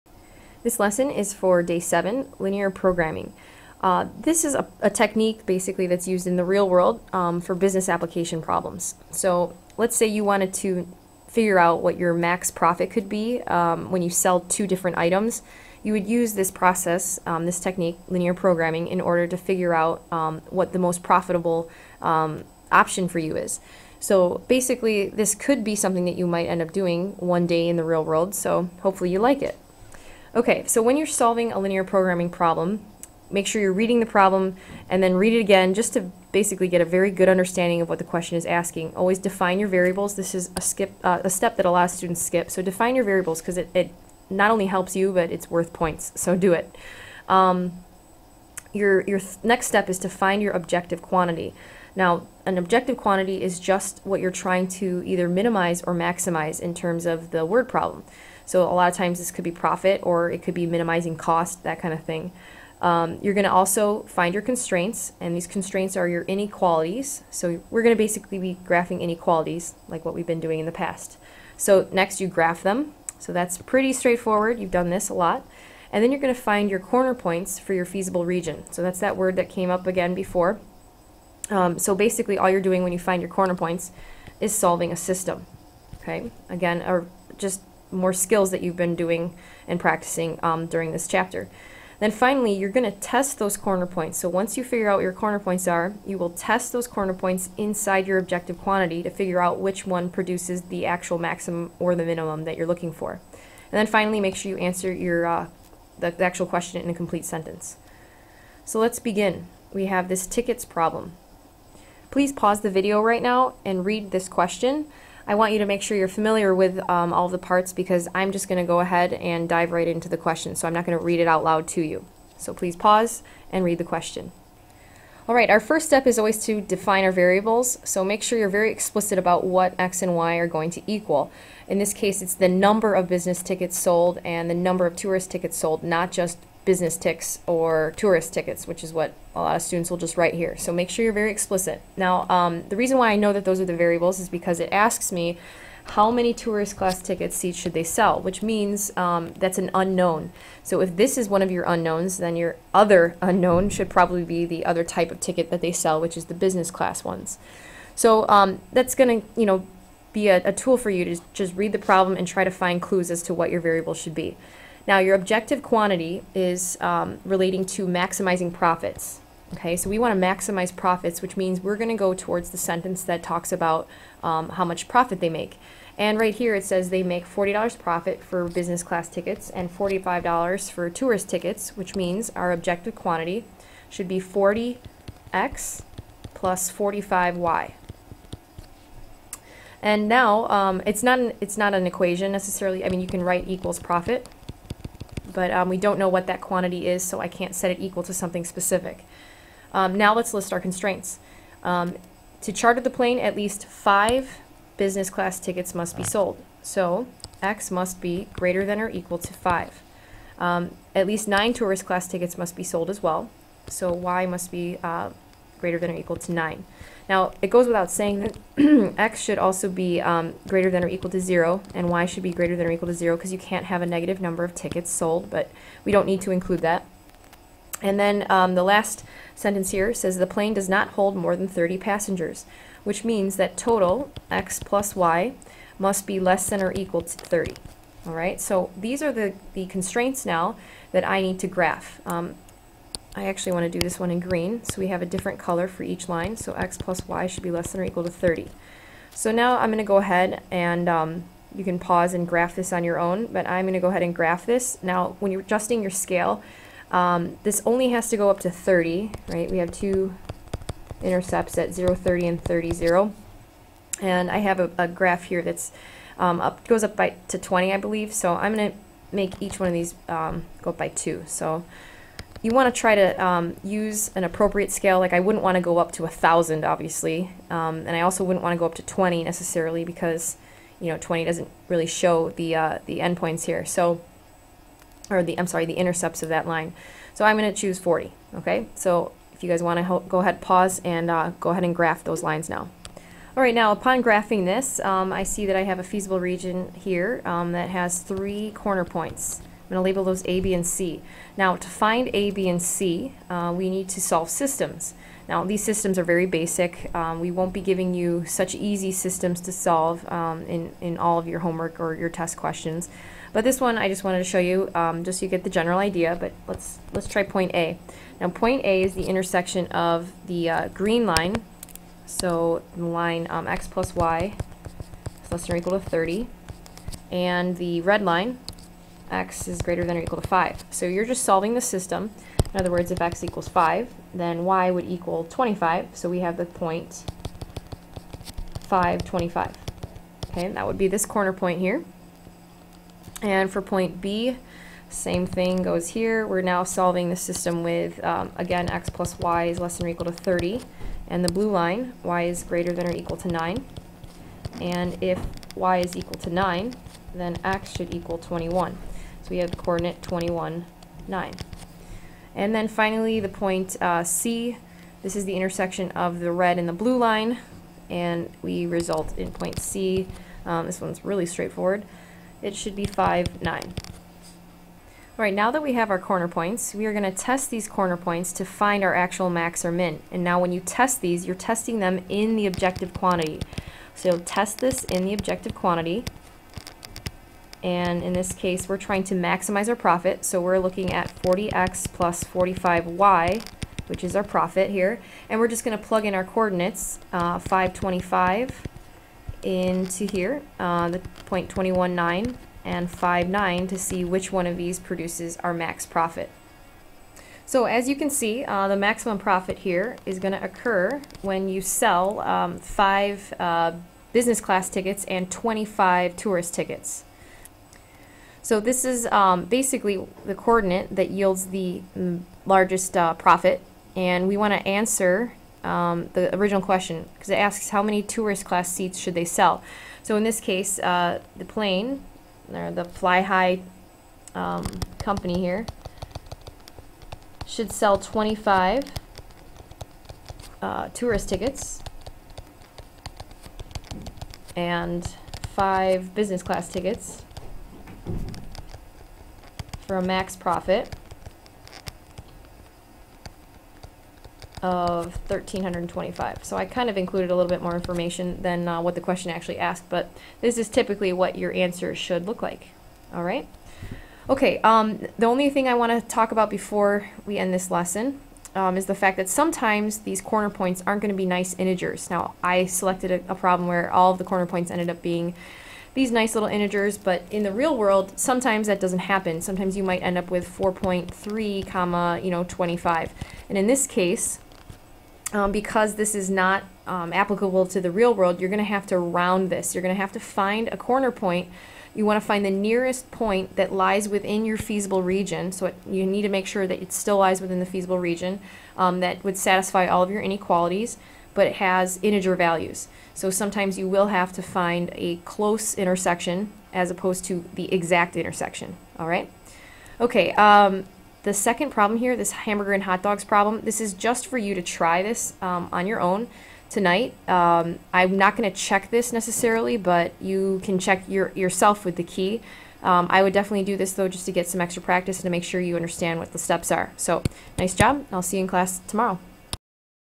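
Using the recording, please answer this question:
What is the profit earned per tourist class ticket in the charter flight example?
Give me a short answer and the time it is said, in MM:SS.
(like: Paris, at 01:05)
$45, at 02:59.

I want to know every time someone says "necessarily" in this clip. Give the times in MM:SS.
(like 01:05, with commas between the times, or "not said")
03:12, 04:39, 08:39.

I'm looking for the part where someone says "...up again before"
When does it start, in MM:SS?
01:19.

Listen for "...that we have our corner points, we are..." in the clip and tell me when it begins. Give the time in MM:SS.
06:15.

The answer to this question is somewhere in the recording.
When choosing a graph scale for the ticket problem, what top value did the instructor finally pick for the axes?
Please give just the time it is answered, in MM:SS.
04:47.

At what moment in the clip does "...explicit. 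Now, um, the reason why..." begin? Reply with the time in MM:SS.
02:21.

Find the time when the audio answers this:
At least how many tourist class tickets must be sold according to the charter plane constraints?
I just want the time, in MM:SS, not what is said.
03:30.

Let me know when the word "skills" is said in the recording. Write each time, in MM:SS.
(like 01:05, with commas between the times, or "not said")
01:28.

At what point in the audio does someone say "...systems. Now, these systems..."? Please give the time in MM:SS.
05:04.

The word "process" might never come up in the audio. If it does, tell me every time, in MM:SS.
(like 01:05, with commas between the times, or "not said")
00:16.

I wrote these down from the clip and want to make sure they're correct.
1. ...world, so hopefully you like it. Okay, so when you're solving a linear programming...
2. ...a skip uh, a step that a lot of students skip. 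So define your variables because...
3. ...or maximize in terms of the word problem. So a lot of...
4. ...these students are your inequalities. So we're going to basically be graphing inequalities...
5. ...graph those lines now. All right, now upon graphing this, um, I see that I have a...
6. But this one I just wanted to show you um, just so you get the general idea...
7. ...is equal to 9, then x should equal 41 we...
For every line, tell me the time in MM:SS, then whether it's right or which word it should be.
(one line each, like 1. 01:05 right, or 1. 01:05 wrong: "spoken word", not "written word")
1. 00:28 right
2. 00:40 right
3. 00:55 right
4. 01:05 wrong: "constraints", not "students"
5. 04:51 right
6. 05:13 right
7. 05:55 wrong: "21", not "41".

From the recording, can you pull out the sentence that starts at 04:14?
Now, when you're adjusting your scale, um, this only has to go up to 30, right?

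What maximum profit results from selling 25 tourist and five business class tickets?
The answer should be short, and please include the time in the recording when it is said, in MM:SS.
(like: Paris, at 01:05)
1325, at 07:35.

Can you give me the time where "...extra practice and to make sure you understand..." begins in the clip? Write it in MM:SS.
08:44.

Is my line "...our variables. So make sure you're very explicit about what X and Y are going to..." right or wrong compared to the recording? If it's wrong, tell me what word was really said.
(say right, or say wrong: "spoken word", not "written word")
right.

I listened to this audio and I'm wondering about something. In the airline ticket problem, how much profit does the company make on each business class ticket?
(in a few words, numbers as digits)
$40.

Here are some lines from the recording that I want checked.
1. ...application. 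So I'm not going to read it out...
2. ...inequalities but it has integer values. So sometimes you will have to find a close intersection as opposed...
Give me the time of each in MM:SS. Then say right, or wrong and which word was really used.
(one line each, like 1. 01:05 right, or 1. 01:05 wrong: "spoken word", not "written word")
1. 02:00 wrong: "question", not "application"
2. 08:20 right.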